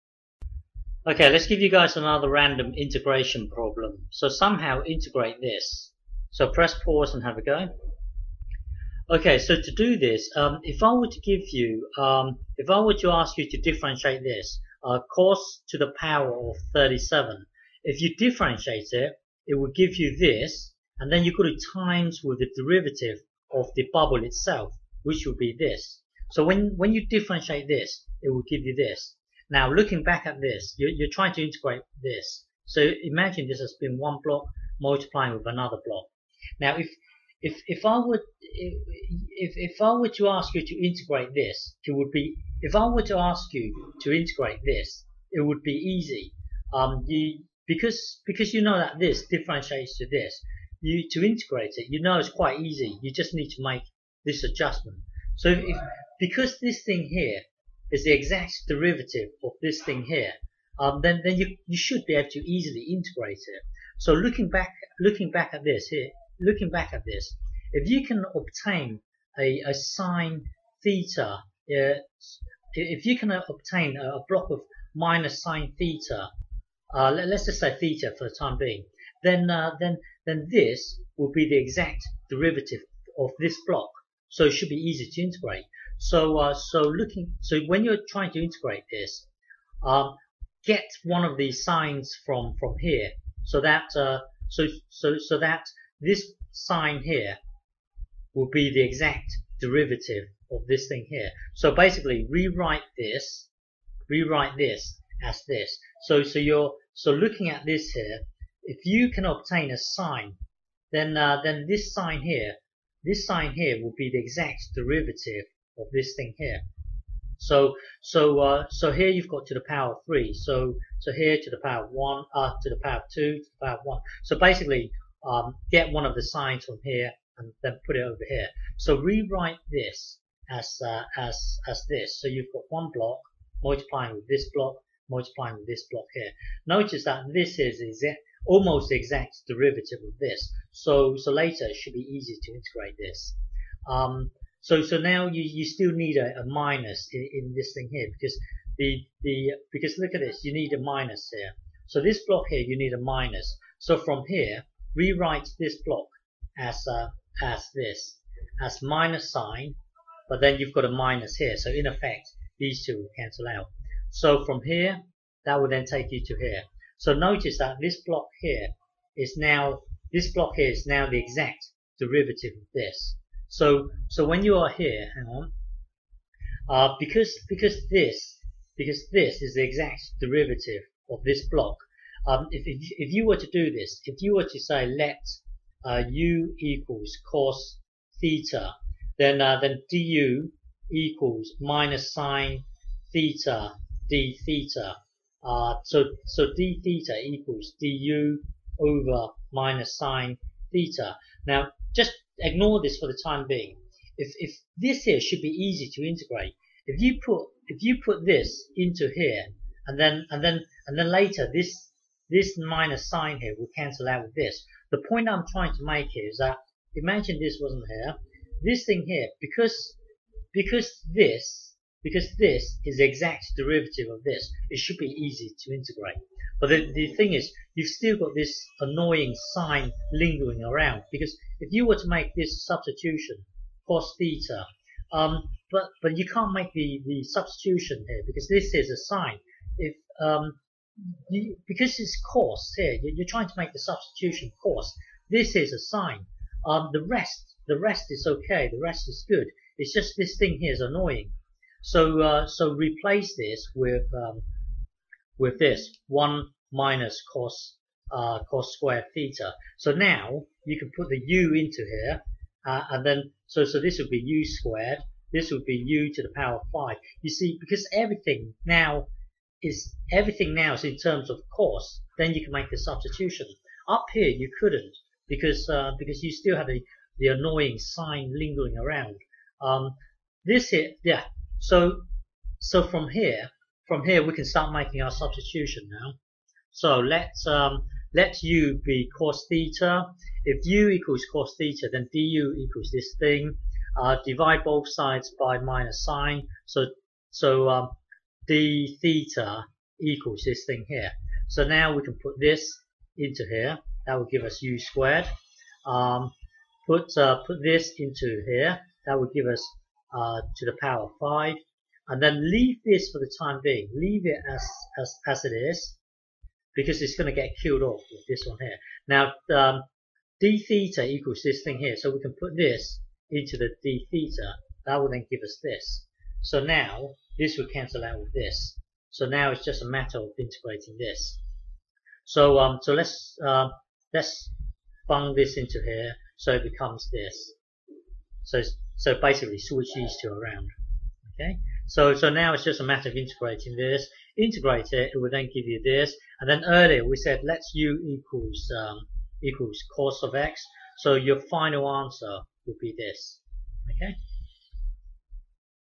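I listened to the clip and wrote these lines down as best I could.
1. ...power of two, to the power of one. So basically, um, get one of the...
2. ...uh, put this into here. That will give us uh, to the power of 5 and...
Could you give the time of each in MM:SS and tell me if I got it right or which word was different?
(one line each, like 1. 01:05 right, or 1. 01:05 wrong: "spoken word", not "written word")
1. 02:02 right
2. 05:07 right.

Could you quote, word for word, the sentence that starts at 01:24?
So it should be easy to integrate.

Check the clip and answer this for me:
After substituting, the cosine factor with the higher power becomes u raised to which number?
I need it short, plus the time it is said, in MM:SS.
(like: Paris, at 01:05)
5, at 04:25.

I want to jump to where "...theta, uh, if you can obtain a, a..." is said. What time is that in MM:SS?
01:10.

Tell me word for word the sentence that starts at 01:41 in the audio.
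So basically, rewrite this, rewrite this as this.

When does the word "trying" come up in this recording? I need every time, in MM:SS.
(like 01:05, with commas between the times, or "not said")
00:31, 01:28, 03:35, 04:03.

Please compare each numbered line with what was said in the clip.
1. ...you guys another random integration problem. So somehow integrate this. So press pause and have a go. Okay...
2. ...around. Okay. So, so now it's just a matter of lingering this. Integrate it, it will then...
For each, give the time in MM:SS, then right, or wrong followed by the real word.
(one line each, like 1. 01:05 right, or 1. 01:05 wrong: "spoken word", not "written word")
1. 00:01 right
2. 05:40 wrong: "integrating", not "lingering".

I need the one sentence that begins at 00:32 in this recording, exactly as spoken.
So imagine this has been one block multiplying with another block.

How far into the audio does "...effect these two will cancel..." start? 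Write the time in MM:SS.
02:41.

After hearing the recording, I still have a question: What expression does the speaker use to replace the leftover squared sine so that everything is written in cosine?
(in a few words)
1 minus cos squared theta.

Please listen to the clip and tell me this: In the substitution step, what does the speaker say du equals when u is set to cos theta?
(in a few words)
minus sine theta d theta.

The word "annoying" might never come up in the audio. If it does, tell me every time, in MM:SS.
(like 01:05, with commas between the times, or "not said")
03:48, 04:10, 04:37.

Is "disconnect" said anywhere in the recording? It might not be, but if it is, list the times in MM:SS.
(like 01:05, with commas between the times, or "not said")
not said.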